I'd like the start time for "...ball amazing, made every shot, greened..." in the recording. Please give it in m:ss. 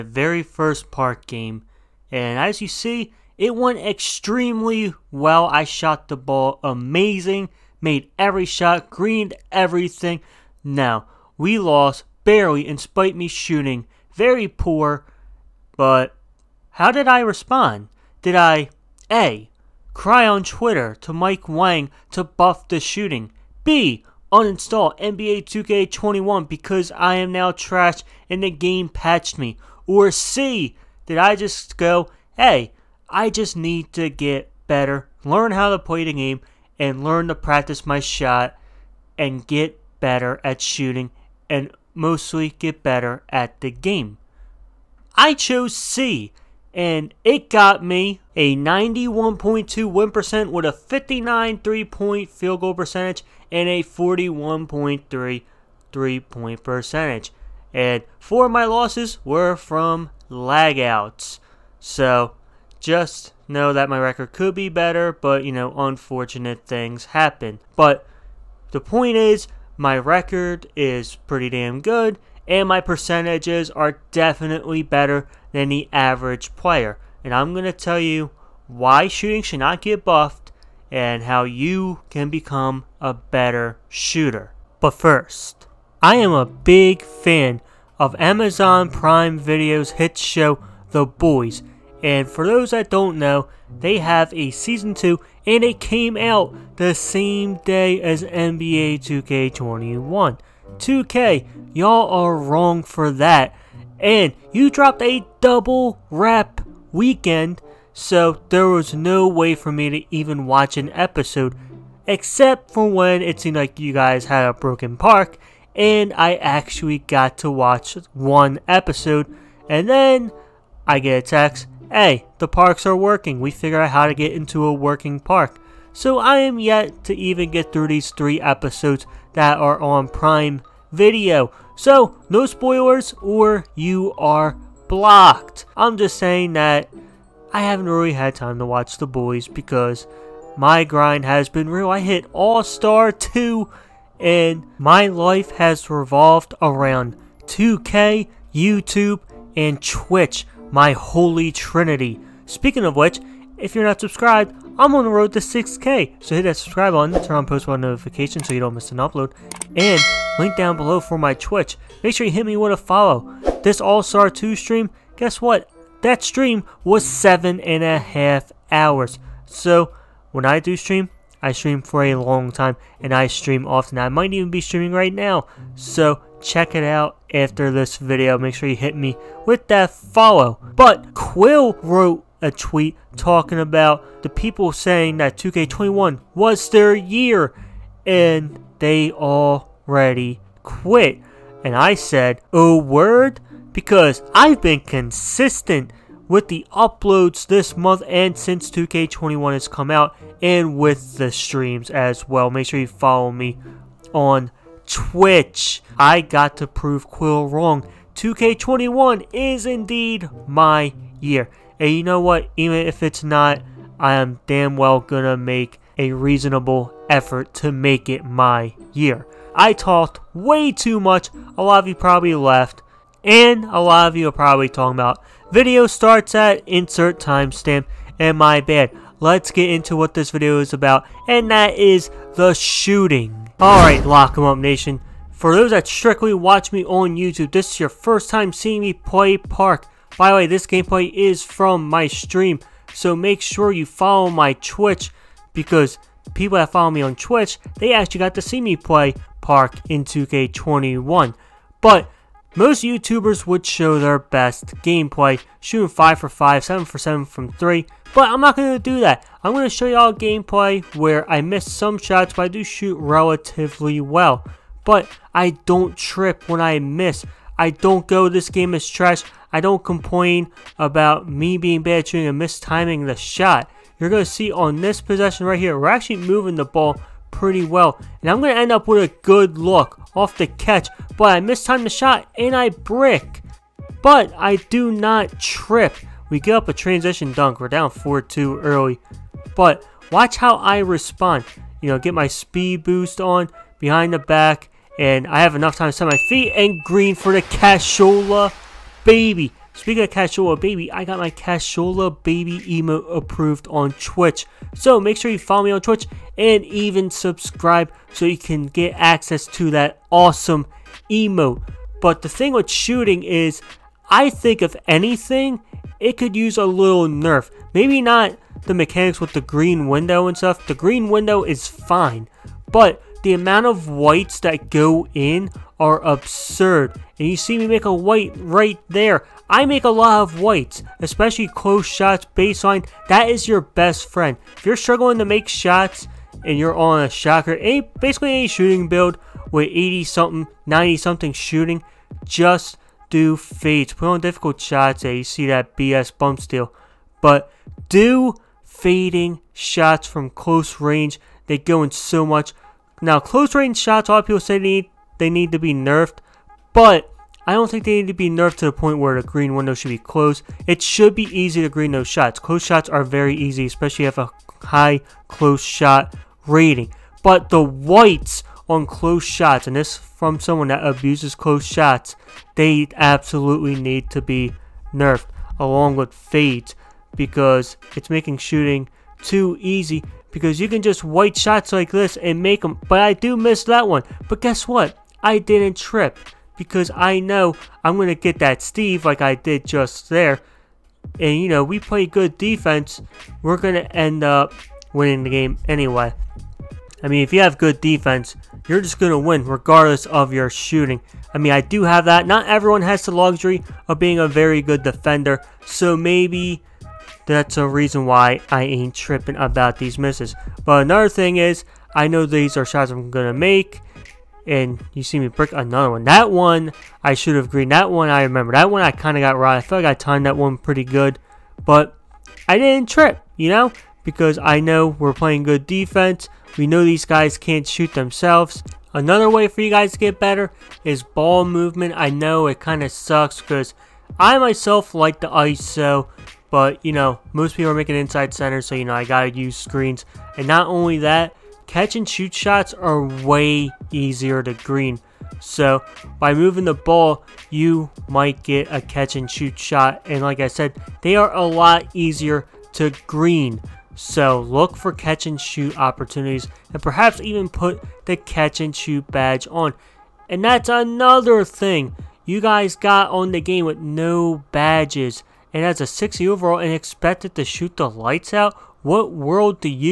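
0:06.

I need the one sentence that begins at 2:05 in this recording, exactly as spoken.
So I am yet to even get through these three episodes that are on Prime Video.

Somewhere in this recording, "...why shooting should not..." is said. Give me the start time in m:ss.
1:18.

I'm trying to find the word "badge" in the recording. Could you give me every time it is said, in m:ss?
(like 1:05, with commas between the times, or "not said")
7:39, 7:44.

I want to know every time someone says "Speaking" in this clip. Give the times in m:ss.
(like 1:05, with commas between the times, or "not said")
2:32, 4:59.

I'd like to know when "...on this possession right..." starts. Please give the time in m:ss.
4:34.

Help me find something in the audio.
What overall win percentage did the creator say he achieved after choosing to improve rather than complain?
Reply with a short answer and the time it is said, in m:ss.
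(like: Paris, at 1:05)
91.2, at 0:48.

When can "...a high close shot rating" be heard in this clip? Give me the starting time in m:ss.
6:04.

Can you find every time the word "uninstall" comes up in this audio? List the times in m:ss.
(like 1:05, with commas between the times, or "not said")
0:24.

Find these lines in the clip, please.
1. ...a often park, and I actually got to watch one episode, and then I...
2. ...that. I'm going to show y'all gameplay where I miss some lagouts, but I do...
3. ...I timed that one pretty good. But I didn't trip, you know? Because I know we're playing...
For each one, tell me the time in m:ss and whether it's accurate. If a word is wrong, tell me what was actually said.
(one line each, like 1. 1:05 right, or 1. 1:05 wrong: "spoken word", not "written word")
1. 1:54 wrong: "broken", not "often"
2. 4:18 wrong: "shots", not "lagouts"
3. 6:59 right.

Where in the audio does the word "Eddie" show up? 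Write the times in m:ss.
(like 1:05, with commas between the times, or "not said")
not said.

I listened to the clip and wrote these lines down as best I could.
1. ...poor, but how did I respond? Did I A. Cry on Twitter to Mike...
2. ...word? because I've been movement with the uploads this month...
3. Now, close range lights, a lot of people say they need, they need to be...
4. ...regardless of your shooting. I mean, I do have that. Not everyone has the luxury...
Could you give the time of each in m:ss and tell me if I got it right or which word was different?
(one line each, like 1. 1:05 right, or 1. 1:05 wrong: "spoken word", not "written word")
1. 0:14 right
2. 3:12 wrong: "consistent", not "movement"
3. 5:53 wrong: "shots", not "lights"
4. 6:39 right.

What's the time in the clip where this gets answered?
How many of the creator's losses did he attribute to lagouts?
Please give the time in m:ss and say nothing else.
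0:58.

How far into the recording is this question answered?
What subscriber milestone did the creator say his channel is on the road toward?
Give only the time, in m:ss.
2:35.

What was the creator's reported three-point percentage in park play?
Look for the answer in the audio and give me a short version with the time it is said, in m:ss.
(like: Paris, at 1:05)
41.3, at 0:53.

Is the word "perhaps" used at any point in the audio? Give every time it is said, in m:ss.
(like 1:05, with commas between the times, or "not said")
7:36.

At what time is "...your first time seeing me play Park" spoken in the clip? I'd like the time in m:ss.
3:57.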